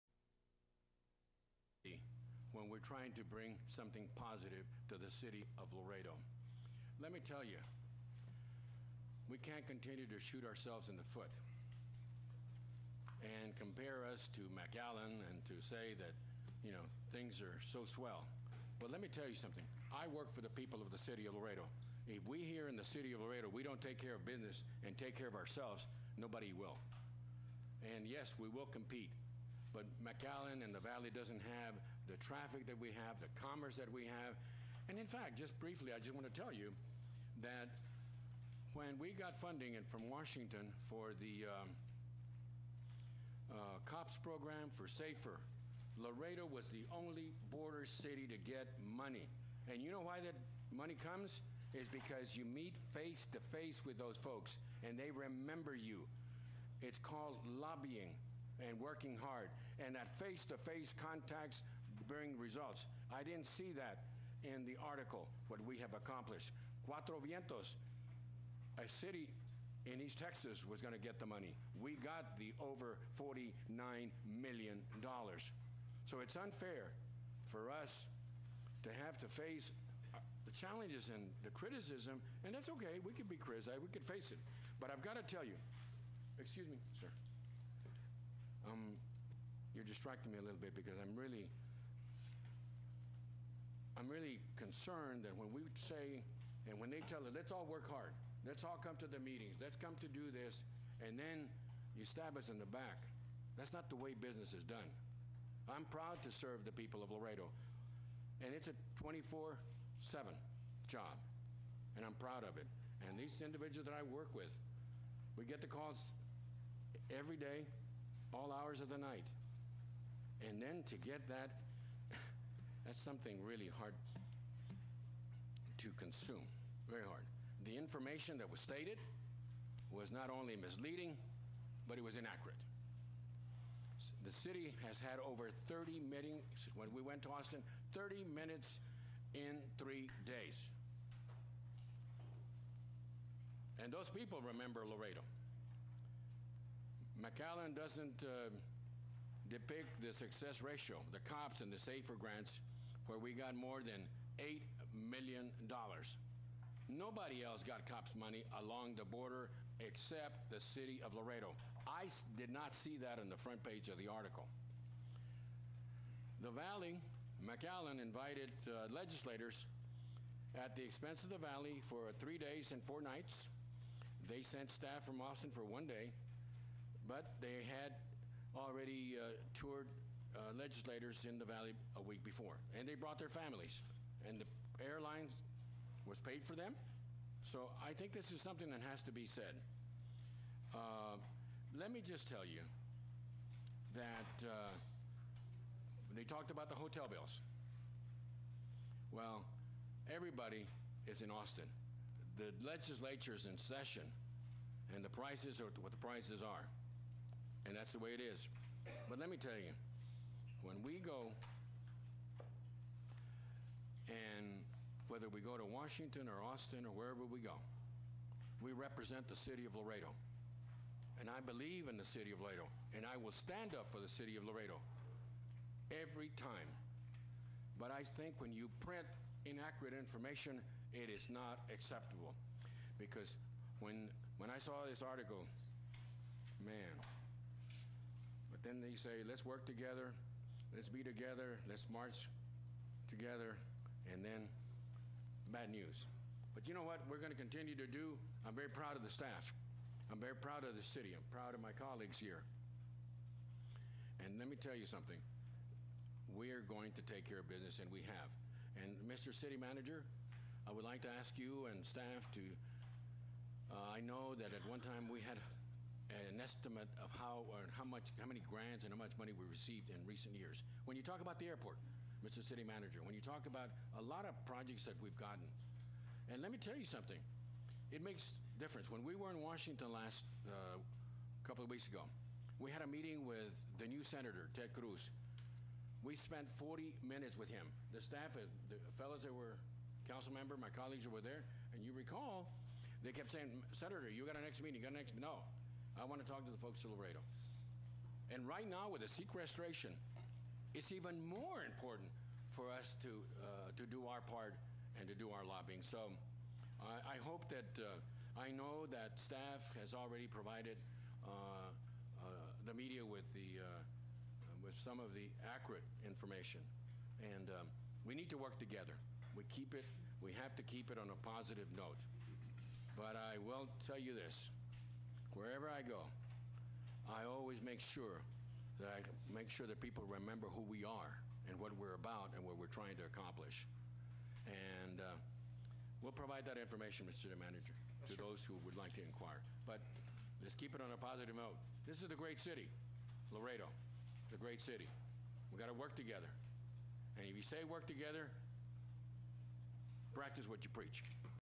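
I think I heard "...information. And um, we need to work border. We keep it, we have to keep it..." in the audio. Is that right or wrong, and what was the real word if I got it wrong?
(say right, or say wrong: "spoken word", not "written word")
wrong: "together", not "border".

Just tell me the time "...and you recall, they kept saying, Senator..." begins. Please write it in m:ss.
4:51.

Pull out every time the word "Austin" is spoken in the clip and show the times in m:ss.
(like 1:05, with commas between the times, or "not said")
2:17, 2:55, 3:21, 3:36.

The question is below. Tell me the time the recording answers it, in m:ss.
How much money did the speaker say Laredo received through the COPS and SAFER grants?
2:33.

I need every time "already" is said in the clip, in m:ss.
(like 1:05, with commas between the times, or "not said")
2:58, 5:09.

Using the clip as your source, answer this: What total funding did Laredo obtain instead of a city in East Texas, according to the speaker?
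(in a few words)
over $49 million.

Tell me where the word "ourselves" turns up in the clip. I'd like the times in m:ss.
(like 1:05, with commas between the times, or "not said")
0:10, 0:25.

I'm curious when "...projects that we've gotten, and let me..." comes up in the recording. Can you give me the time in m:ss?
4:34.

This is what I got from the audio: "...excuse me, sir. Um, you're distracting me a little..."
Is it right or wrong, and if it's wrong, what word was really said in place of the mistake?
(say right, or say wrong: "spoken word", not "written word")
right.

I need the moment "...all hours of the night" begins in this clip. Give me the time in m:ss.
1:58.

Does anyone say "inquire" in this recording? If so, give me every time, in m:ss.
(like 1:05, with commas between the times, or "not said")
5:39.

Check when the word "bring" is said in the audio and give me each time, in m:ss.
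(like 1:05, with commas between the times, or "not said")
0:03, 1:02.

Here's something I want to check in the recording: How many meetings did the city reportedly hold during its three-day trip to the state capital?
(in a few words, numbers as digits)
30.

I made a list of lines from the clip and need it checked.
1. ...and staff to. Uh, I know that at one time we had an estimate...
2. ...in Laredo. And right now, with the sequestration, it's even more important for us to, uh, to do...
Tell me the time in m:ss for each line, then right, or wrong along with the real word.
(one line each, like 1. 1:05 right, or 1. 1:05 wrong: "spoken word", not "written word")
1. 4:21 right
2. 4:56 right.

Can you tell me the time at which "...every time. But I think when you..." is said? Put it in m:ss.
3:45.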